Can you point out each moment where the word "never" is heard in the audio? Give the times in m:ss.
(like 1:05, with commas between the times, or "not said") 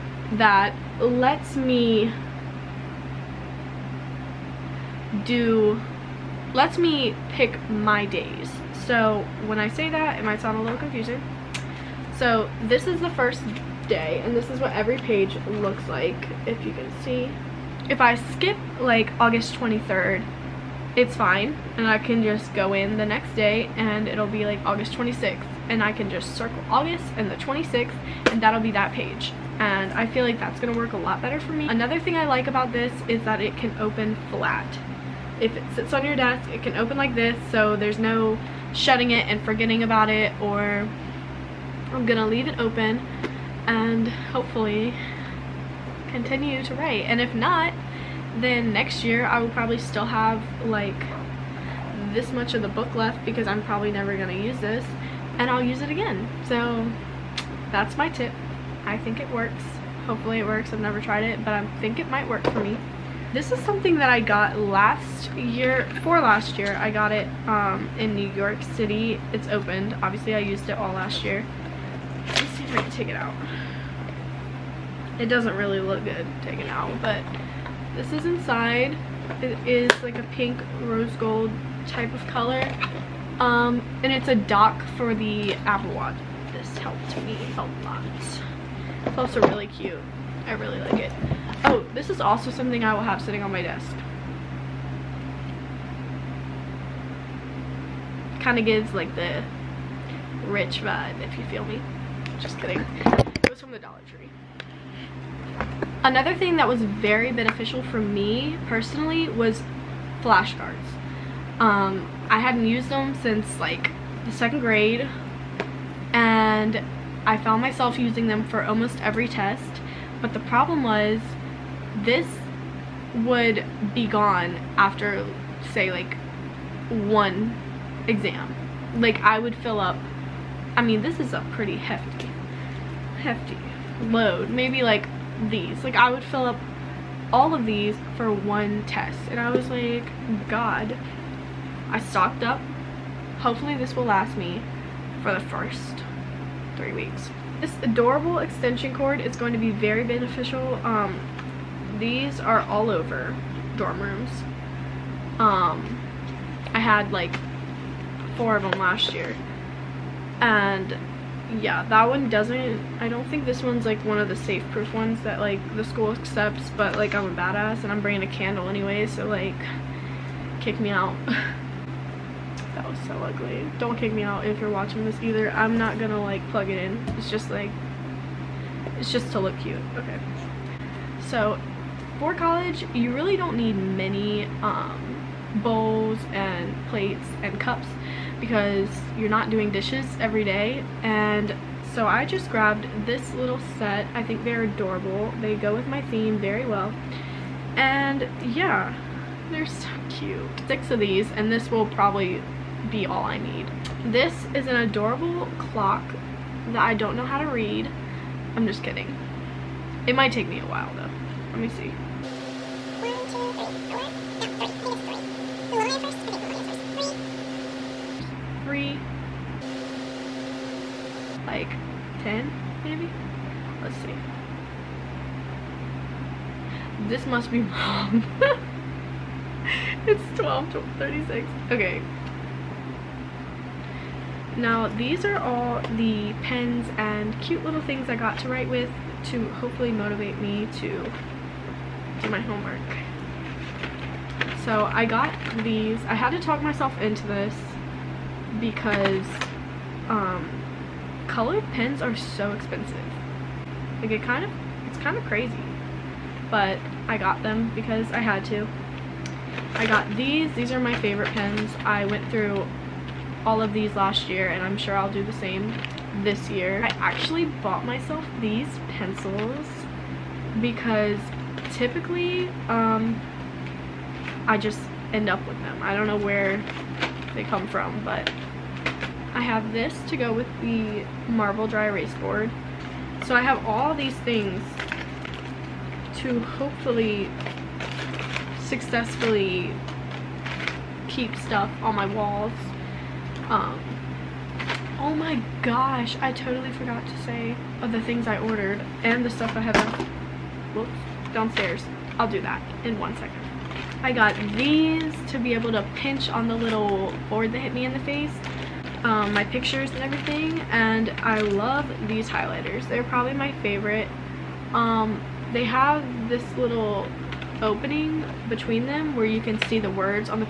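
0:53, 1:00.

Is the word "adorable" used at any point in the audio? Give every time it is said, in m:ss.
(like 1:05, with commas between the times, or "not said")
2:27, 3:14, 3:24.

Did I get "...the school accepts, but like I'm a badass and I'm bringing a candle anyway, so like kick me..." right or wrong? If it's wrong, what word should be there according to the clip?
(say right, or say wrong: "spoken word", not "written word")
right.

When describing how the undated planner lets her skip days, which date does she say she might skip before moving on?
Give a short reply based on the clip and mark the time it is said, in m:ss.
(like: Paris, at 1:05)
August 23rd, at 0:19.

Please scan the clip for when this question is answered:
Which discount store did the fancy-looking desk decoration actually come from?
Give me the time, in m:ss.
1:43.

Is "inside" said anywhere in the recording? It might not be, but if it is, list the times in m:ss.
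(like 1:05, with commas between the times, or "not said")
1:18.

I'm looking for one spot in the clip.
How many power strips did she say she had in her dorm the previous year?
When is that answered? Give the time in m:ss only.
2:38.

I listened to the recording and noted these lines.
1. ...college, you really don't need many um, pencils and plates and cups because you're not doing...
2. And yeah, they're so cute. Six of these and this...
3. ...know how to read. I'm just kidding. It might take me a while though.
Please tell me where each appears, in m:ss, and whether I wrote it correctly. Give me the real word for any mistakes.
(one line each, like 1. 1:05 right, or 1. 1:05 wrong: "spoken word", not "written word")
1. 3:02 wrong: "bowls", not "pencils"
2. 3:17 right
3. 3:27 right.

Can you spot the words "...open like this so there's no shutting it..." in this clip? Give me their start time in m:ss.
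0:36.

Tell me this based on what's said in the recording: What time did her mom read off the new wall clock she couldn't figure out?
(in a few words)
12:36.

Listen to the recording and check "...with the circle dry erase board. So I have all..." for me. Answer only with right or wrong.
wrong.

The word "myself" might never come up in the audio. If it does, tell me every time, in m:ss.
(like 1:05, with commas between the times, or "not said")
1:57, 4:06, 4:27.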